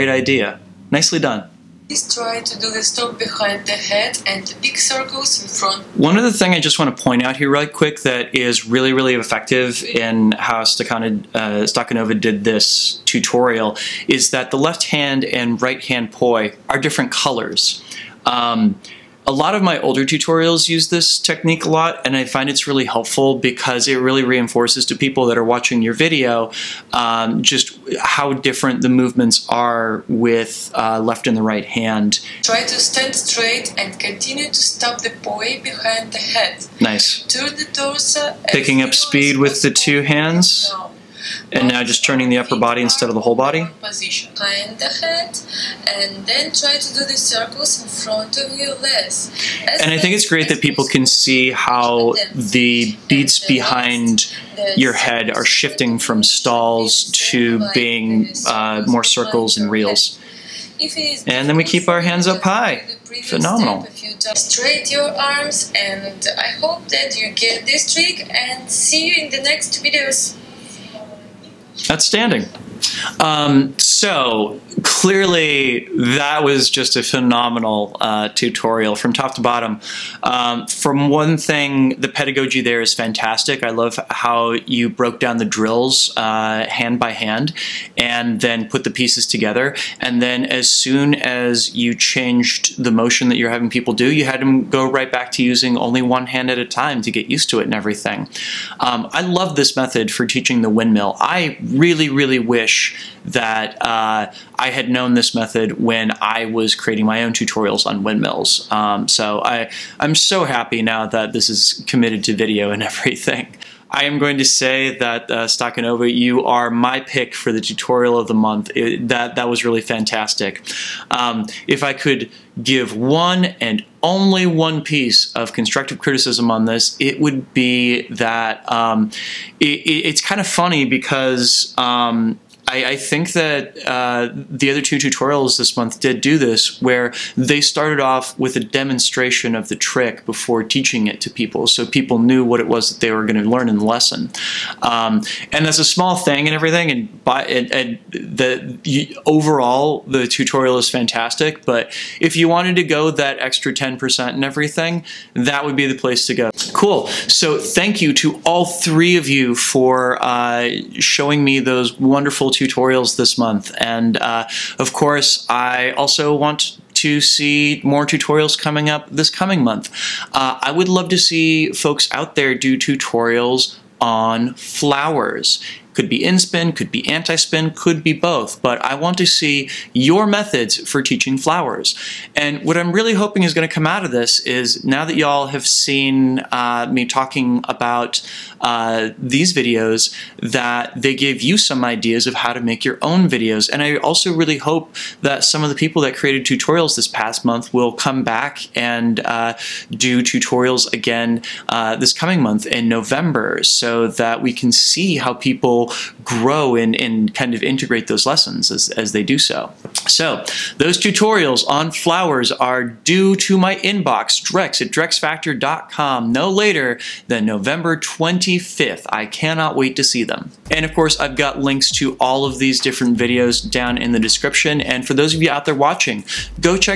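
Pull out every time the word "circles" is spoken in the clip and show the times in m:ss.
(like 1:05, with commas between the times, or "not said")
0:04, 0:47, 0:59.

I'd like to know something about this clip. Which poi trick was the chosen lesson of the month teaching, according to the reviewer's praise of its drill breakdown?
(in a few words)
Windmill.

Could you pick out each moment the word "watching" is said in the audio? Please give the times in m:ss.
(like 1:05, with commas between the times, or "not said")
0:25, 3:45.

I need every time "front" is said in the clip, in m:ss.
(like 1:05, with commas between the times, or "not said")
0:05, 0:47.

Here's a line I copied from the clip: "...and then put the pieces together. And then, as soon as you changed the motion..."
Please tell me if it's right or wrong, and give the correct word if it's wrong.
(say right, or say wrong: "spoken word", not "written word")
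right.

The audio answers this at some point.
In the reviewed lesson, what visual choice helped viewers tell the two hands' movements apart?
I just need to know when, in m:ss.
0:16.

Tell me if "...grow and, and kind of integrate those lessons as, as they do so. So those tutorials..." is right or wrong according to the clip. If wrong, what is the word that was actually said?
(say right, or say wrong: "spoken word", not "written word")
right.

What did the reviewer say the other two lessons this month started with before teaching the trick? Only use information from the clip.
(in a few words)
A demonstration.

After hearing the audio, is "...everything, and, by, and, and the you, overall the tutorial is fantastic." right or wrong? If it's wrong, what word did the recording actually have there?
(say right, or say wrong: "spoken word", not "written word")
right.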